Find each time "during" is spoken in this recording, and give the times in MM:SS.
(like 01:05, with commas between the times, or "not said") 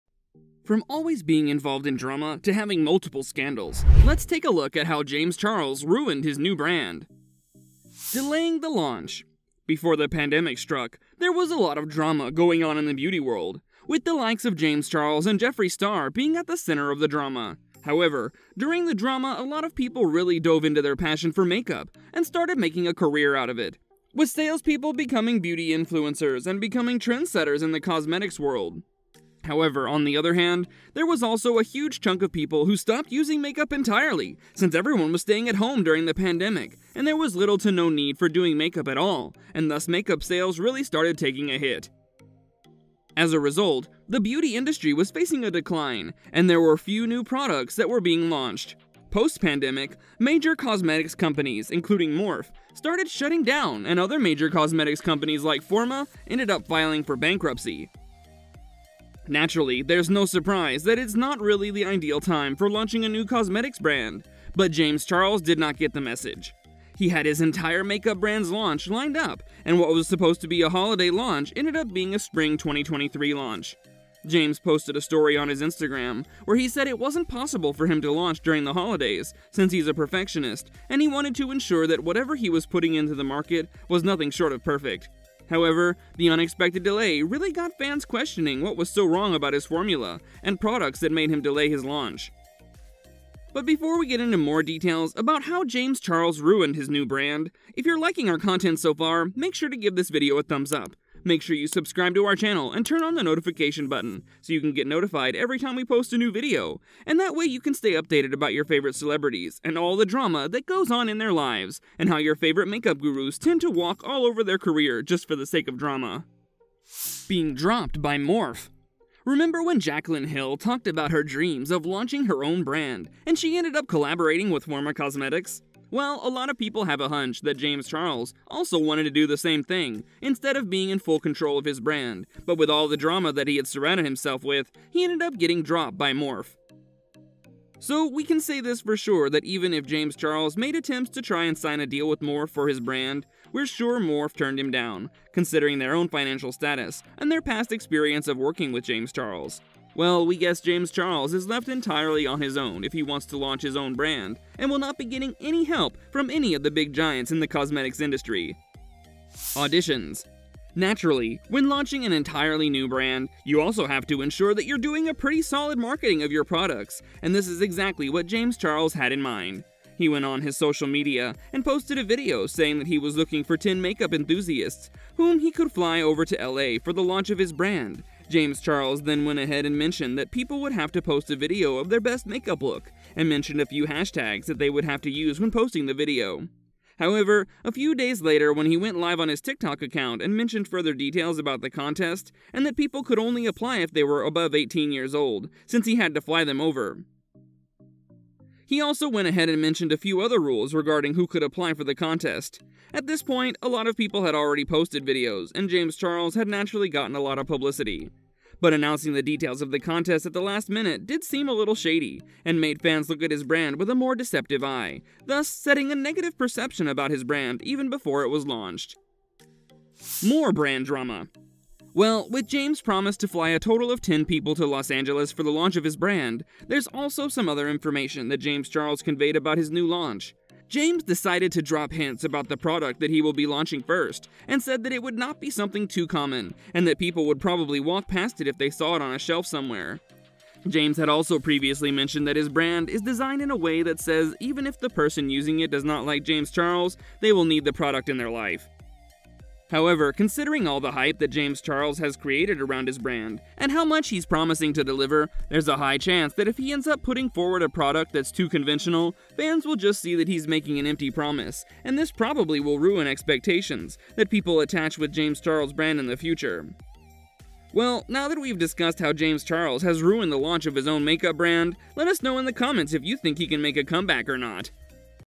00:18, 00:35, 01:18.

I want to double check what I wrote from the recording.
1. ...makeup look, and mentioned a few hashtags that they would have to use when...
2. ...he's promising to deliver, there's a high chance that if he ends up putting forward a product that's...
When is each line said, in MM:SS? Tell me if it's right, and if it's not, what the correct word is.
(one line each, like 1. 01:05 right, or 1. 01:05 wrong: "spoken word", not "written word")
1. 03:02 right
2. 04:14 right.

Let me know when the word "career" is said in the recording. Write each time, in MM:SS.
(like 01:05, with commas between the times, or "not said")
00:22, 01:54.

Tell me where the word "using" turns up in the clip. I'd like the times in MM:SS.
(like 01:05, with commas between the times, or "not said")
00:33, 04:05.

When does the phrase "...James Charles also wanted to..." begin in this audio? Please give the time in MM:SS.
02:07.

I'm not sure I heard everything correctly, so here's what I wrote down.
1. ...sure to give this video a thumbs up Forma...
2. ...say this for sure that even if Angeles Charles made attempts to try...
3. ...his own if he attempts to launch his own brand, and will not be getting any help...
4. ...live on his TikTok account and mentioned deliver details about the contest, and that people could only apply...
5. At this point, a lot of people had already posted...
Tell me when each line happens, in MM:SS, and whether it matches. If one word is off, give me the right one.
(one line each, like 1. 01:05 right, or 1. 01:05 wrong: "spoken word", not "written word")
1. 01:39 wrong: "Make", not "Forma"
2. 02:18 wrong: "James", not "Angeles"
3. 02:32 wrong: "wants", not "attempts"
4. 03:08 wrong: "further", not "deliver"
5. 03:22 right.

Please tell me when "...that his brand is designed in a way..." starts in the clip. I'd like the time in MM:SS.
04:02.